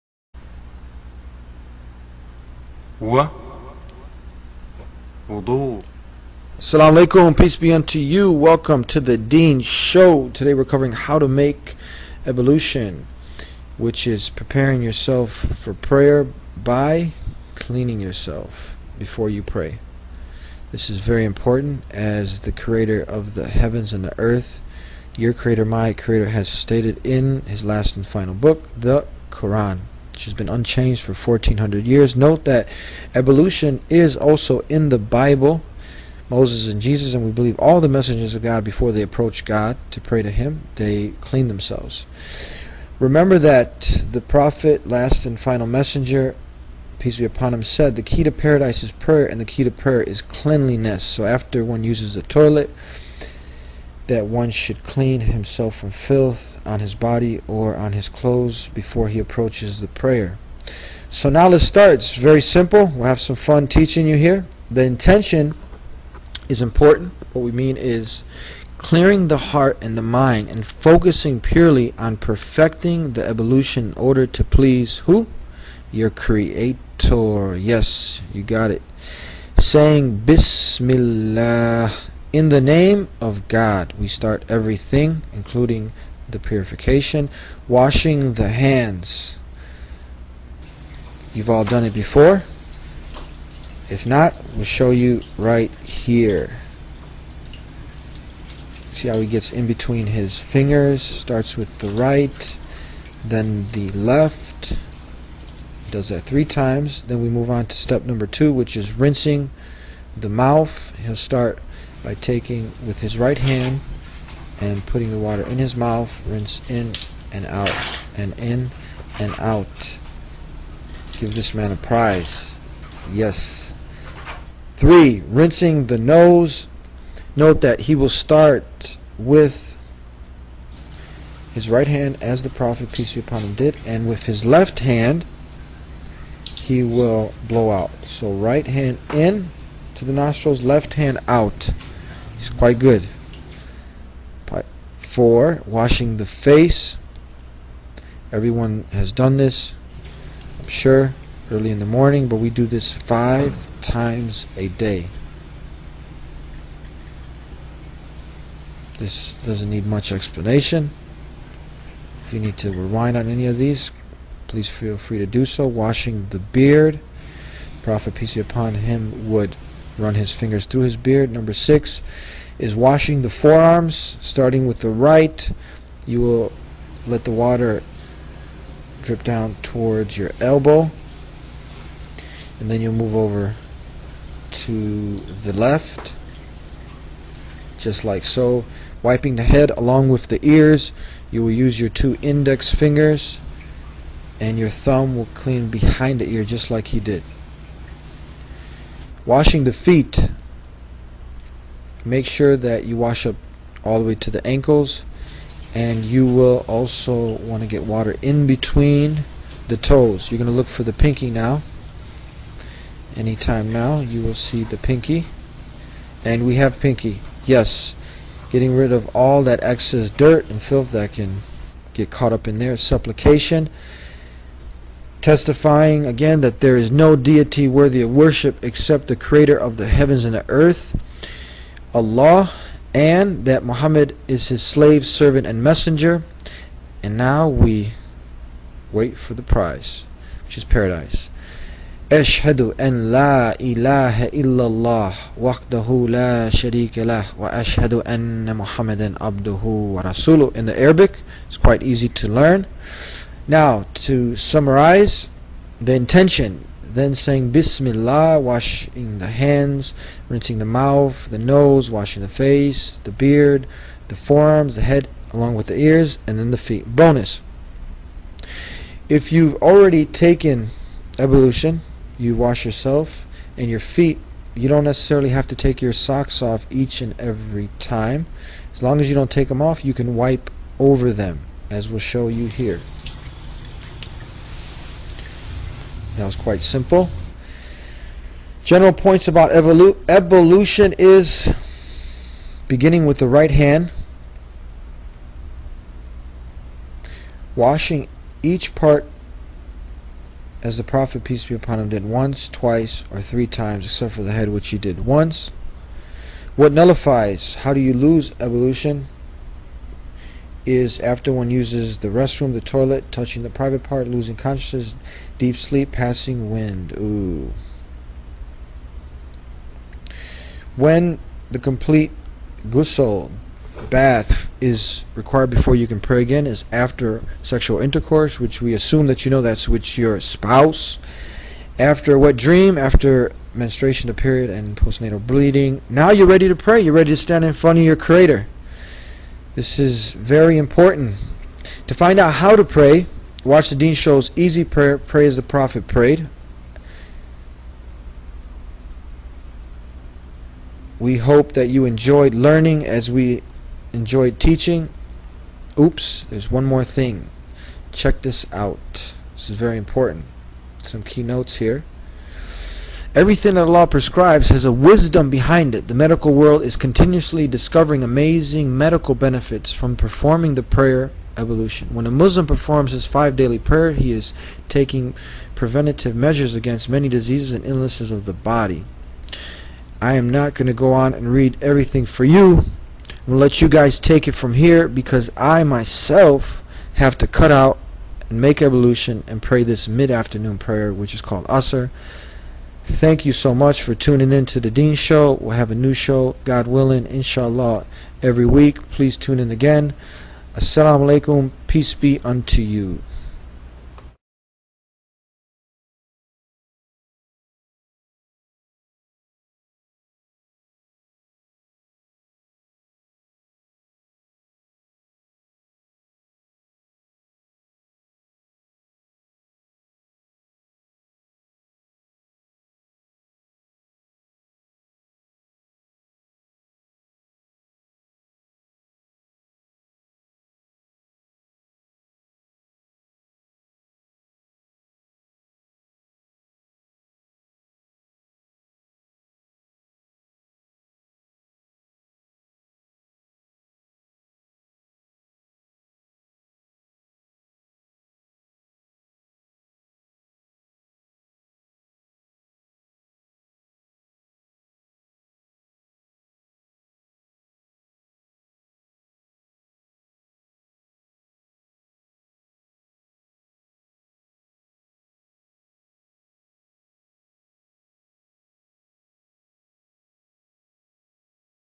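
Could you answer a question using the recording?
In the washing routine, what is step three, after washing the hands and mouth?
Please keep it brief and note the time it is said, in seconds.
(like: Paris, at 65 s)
Rinsing the nose, at 125 s.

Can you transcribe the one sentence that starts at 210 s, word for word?
You're going to look for the pinky now.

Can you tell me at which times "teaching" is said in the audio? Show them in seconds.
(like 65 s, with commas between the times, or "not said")
63 s, 354 s.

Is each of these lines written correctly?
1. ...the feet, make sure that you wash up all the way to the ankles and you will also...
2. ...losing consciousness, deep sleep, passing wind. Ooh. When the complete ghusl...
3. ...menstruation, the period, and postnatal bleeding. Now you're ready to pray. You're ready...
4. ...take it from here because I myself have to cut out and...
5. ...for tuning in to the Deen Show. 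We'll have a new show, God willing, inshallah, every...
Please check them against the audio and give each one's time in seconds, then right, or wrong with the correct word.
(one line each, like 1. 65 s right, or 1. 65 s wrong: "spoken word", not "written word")
1. 199 s right
2. 314 s right
3. 333 s right
4. 383 s right
5. 393 s right.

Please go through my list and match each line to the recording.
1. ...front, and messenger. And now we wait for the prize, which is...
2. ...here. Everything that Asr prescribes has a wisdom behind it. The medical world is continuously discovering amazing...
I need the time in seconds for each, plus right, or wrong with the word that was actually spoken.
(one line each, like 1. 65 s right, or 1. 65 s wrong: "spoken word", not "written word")
1. 235 s wrong: "servant", not "front"
2. 361 s wrong: "Allah", not "Asr".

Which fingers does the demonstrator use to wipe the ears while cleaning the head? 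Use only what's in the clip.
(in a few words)
Two index fingers.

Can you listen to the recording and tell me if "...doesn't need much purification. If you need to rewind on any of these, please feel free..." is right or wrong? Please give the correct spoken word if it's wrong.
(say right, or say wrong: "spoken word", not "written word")
wrong: "explanation", not "purification".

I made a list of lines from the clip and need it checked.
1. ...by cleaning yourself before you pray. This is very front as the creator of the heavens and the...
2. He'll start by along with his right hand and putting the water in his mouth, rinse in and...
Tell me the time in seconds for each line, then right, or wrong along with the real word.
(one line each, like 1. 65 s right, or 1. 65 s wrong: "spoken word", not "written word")
1. 16 s wrong: "important", not "front"
2. 111 s wrong: "taking", not "along".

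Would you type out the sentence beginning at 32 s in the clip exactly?
Note that ablution is also in the Bible.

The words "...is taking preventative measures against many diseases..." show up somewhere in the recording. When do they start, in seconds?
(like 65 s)
374 s.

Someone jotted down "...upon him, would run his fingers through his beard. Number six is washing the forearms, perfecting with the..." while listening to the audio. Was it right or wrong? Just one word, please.
wrong.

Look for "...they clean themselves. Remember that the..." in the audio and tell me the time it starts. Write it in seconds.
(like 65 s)
40 s.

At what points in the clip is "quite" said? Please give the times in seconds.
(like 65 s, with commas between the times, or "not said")
142 s, 251 s, 286 s.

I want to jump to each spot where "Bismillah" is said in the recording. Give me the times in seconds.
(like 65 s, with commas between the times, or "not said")
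80 s, 257 s.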